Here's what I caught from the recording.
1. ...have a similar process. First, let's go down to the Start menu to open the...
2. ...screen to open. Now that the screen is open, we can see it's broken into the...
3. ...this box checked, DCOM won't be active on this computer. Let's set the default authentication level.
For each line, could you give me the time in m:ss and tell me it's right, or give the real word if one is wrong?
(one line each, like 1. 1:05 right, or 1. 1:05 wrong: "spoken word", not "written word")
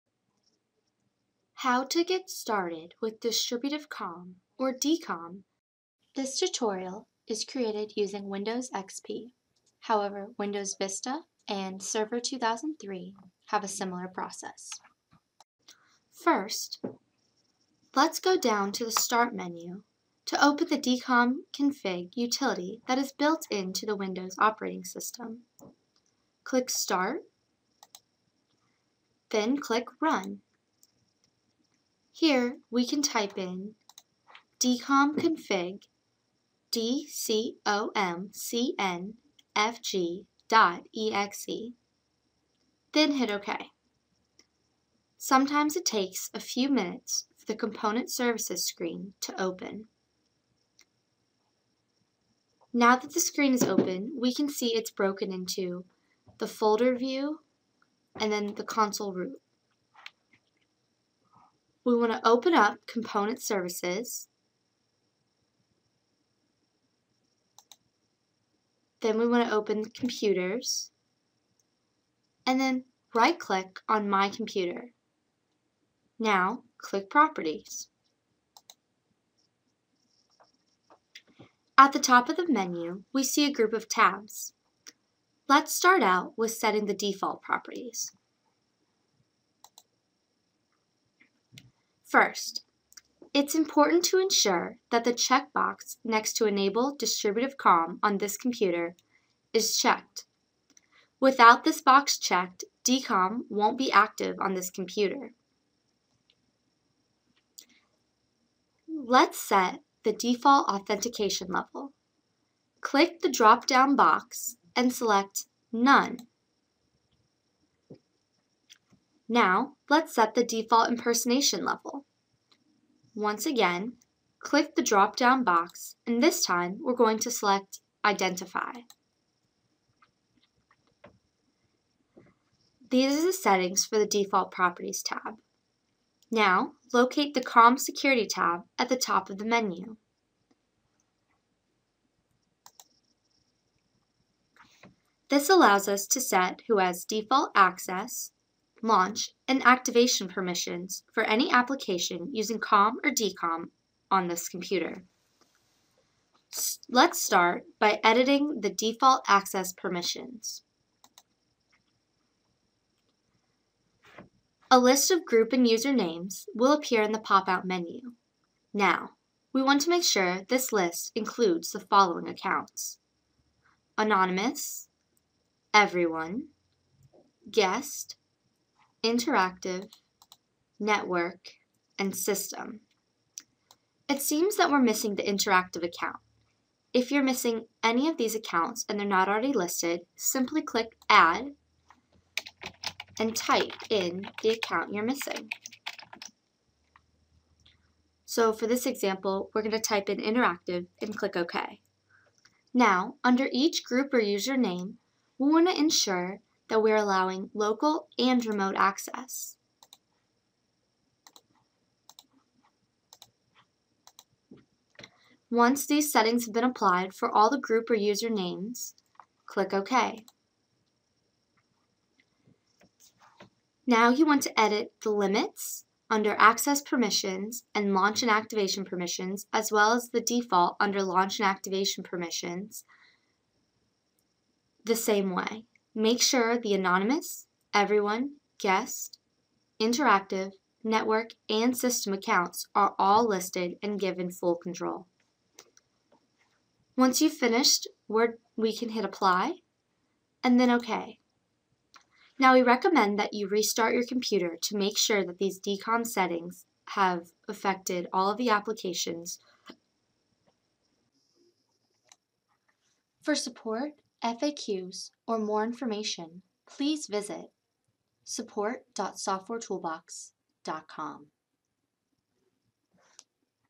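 1. 0:13 right
2. 0:48 right
3. 1:41 right.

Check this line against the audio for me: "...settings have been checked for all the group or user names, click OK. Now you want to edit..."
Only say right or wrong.
wrong.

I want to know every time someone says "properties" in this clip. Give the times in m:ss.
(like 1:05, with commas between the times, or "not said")
1:17, 1:27, 2:14.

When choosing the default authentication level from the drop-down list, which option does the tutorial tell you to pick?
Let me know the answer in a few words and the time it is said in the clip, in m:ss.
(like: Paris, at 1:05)
None, at 1:55.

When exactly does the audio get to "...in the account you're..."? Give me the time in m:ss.
3:13.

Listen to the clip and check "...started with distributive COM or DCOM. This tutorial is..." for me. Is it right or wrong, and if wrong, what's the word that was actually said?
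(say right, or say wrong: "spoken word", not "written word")
right.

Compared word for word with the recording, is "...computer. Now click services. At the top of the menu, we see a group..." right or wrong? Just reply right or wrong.
wrong.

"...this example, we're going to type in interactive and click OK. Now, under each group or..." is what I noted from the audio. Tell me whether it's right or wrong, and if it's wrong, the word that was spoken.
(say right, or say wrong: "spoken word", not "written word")
right.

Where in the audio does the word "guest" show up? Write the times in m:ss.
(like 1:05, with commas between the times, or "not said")
2:57, 3:58.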